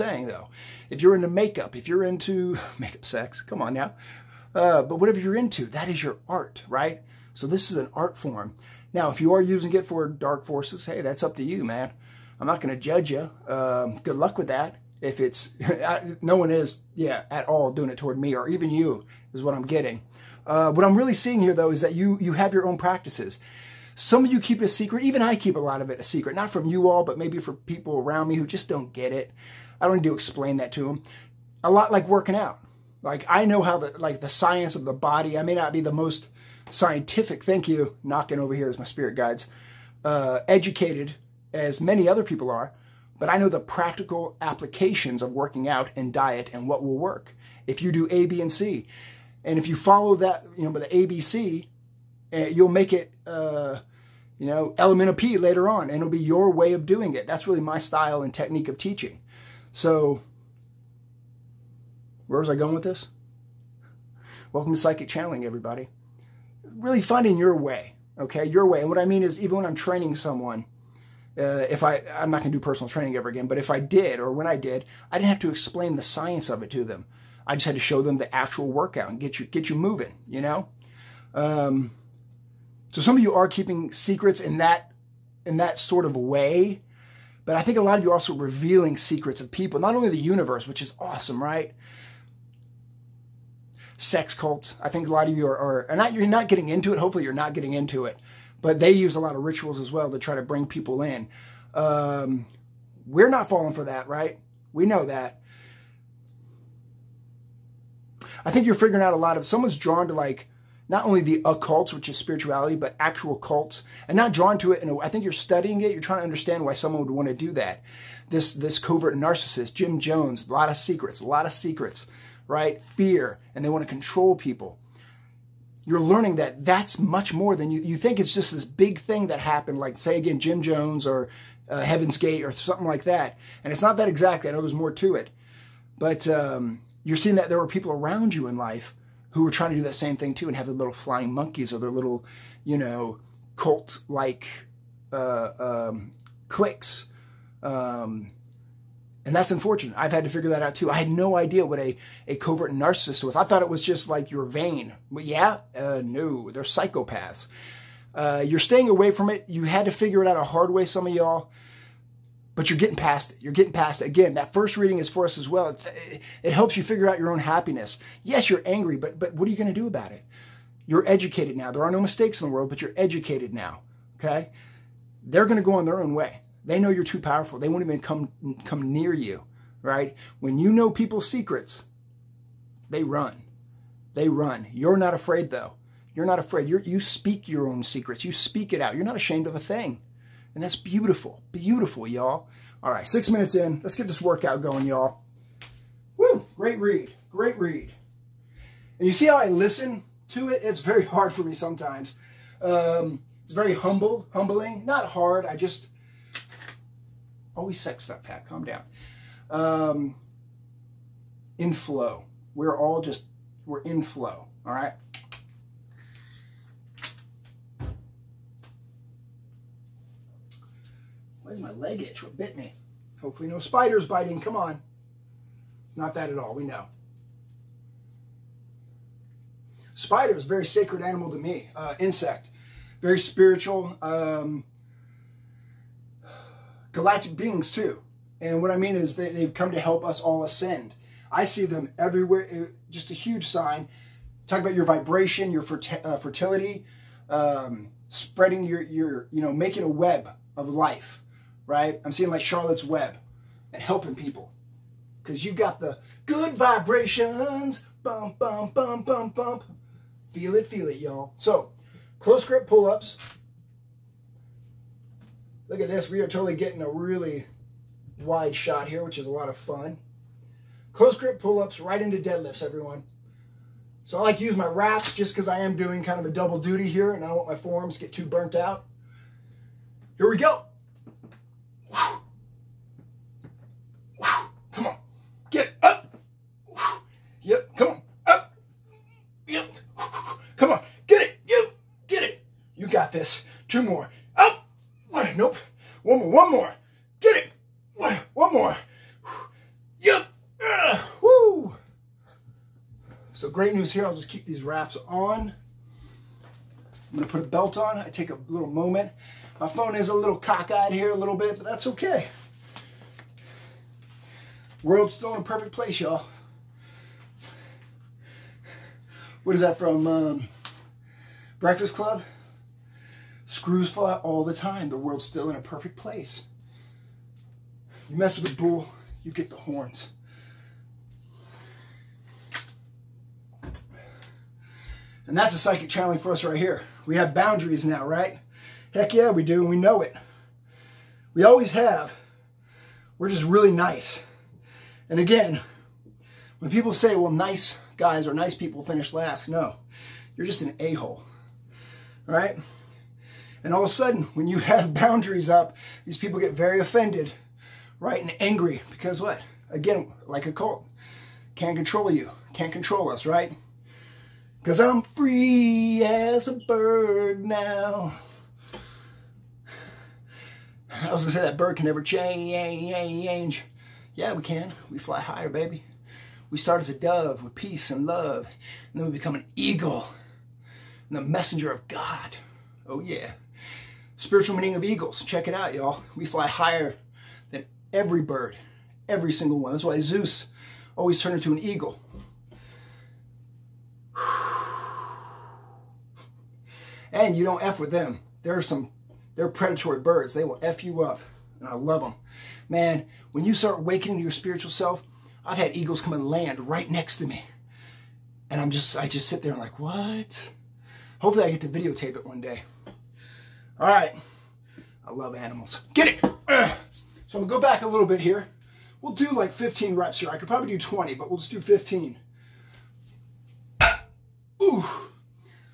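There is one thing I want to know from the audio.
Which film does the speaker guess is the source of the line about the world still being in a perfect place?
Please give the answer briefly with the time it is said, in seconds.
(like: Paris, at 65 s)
Breakfast Club, at 321 s.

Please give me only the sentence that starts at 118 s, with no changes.
This this covert narcissist, Jim Jones, a lot of secrets, a lot of secrets right?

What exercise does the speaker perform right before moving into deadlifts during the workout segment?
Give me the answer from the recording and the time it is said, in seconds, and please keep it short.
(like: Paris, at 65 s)
Close grip pull-ups, at 262 s.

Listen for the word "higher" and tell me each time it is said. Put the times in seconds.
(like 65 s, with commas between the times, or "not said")
375 s, 386 s.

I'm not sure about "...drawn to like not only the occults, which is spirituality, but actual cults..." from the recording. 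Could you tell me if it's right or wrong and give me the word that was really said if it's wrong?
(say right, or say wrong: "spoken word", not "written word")
right.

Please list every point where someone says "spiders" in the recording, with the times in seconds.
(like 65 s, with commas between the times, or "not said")
223 s, 229 s.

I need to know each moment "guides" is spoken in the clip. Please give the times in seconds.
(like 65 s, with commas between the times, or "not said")
39 s.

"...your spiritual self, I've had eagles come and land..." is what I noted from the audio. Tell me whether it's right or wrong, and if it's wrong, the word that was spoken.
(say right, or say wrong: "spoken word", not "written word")
right.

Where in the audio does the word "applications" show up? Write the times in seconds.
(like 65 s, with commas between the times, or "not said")
44 s.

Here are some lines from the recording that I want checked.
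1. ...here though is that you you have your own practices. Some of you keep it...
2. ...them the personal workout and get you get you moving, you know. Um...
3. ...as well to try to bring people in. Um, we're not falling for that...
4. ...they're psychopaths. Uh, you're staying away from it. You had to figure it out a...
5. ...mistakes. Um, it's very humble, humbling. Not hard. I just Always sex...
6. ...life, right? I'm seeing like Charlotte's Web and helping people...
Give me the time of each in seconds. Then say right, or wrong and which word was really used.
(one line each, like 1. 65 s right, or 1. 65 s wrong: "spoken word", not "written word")
1. 21 s right
2. 78 s wrong: "actual", not "personal"
3. 99 s right
4. 156 s right
5. 201 s wrong: "sometimes", not "mistakes"
6. 250 s right.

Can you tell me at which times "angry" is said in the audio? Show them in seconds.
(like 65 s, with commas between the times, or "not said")
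168 s, 358 s.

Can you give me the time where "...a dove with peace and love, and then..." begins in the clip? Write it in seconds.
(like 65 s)
376 s.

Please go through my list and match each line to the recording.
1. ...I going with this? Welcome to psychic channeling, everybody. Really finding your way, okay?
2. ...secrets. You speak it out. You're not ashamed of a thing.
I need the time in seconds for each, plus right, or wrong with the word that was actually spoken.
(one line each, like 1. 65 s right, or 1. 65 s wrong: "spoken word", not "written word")
1. 62 s right
2. 187 s right.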